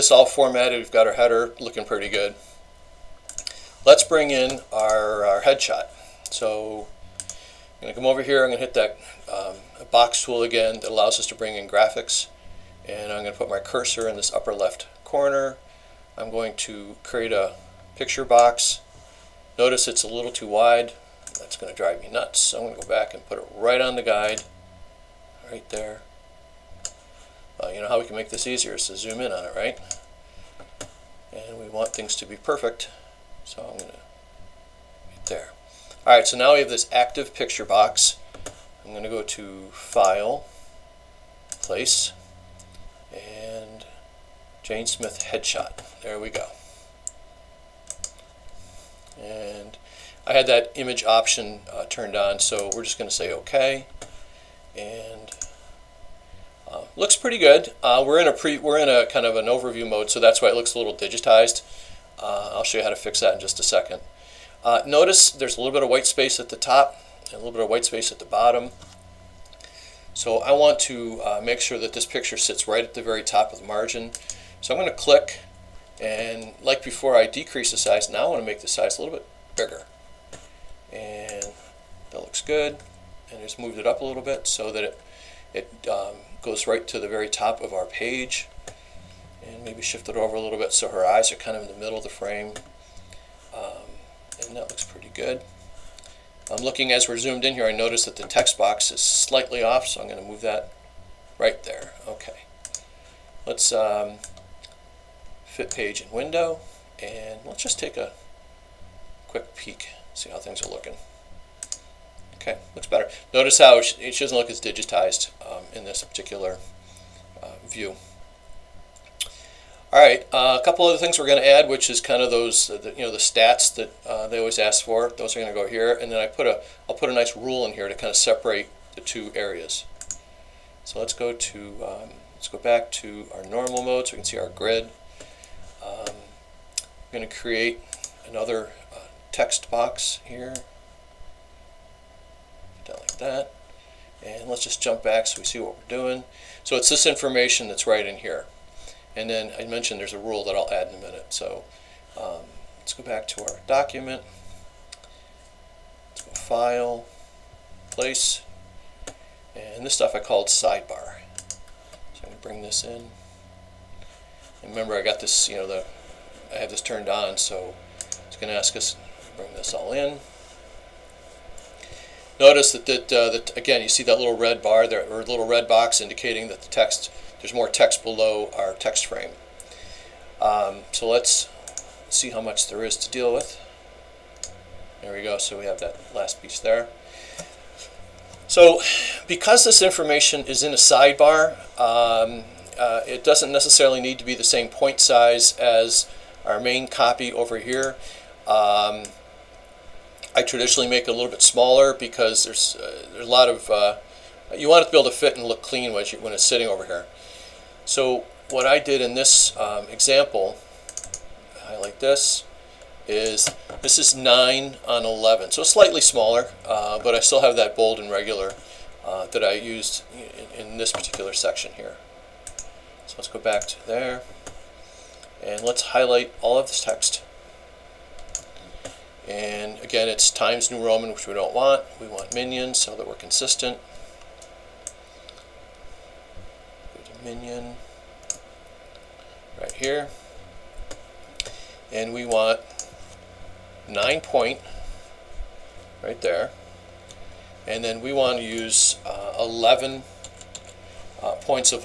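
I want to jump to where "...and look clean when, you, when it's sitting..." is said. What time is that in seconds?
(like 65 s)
205 s.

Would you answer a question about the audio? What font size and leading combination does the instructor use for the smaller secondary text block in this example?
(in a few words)
9 on 11.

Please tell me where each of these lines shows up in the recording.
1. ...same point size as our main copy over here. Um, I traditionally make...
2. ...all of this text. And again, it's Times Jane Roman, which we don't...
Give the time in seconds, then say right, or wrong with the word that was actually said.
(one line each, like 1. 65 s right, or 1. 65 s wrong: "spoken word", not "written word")
1. 194 s right
2. 226 s wrong: "New", not "Jane".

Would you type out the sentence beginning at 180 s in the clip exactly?
Um, so let's see how much there is to deal with.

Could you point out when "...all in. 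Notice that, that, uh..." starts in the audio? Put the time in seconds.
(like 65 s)
169 s.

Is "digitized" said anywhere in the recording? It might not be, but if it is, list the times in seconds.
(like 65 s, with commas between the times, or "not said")
60 s, 114 s.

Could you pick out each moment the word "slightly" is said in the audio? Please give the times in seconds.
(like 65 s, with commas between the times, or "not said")
99 s, 215 s.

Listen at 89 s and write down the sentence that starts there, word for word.
And maybe shift it over a little bit so her eyes are kind of in the middle of the frame.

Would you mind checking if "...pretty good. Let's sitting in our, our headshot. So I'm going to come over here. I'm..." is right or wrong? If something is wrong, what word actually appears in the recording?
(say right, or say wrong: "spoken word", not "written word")
wrong: "bring", not "sitting".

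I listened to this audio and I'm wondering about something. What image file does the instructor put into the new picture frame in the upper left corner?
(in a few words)
Jane Smith headshot.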